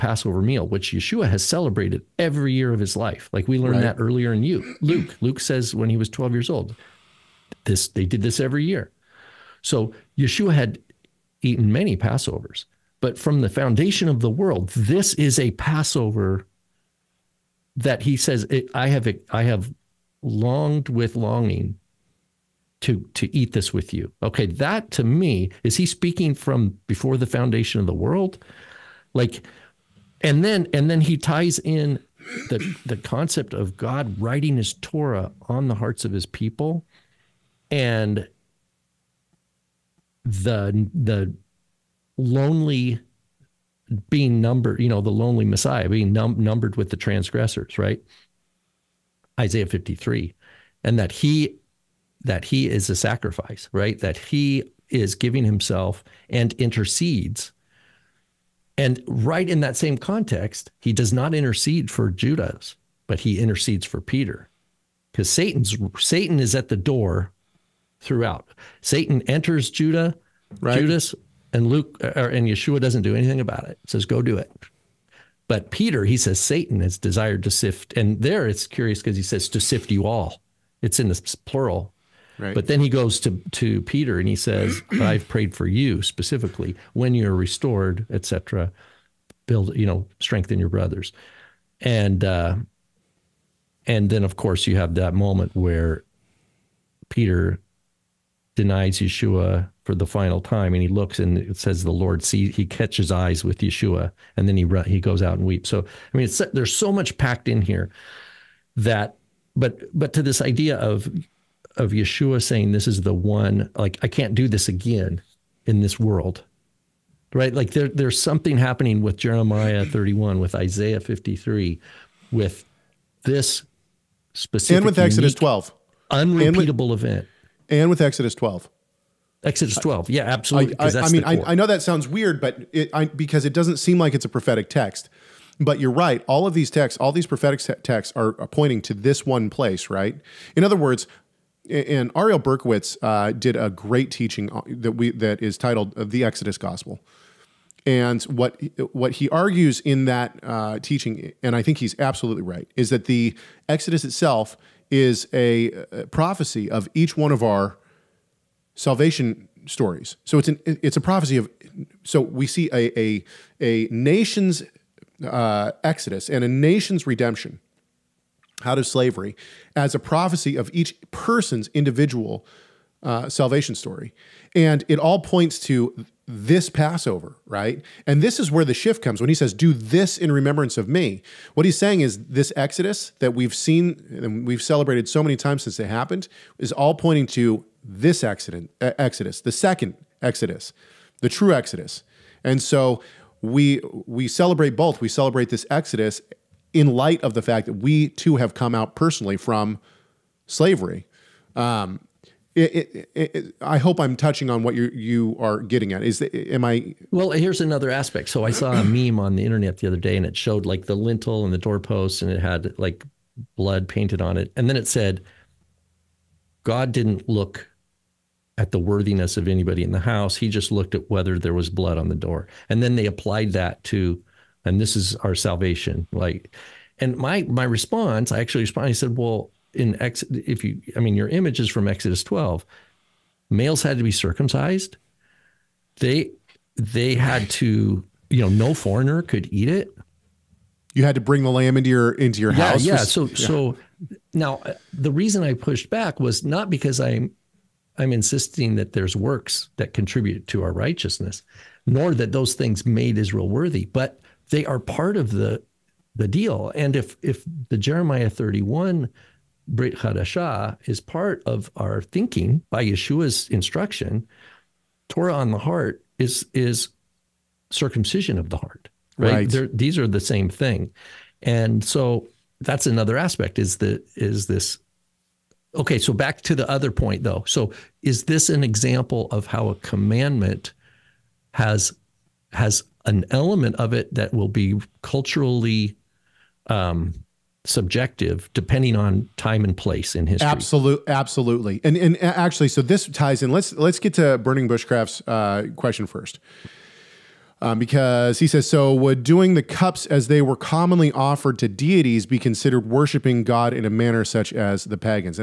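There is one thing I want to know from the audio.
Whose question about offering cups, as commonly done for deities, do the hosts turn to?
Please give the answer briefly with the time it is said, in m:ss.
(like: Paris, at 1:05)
burning bushcraft, at 4:54.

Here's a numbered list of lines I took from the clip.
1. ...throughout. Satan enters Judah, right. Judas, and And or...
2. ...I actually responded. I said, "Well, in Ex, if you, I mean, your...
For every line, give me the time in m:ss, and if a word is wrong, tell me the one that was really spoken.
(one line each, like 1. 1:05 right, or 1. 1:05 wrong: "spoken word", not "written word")
1. 1:07 wrong: "Luke", not "And"
2. 3:48 right.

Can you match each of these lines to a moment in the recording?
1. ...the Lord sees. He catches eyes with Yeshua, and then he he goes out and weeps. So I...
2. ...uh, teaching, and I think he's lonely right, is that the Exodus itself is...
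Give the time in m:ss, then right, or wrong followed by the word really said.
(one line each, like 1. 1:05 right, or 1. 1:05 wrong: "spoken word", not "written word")
1. 1:41 right
2. 2:30 wrong: "absolutely", not "lonely".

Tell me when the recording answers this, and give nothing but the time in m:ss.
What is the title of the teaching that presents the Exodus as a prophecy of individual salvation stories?
2:26.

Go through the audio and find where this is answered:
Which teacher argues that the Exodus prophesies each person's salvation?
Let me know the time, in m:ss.
2:22.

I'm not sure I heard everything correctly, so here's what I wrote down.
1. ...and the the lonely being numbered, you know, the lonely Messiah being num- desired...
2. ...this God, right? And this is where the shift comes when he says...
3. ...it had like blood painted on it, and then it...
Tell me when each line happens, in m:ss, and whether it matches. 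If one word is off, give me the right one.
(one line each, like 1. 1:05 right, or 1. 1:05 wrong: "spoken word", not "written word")
1. 0:37 wrong: "numbered", not "desired"
2. 2:56 wrong: "Passover", not "God"
3. 3:32 right.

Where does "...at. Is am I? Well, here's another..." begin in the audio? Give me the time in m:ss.
3:25.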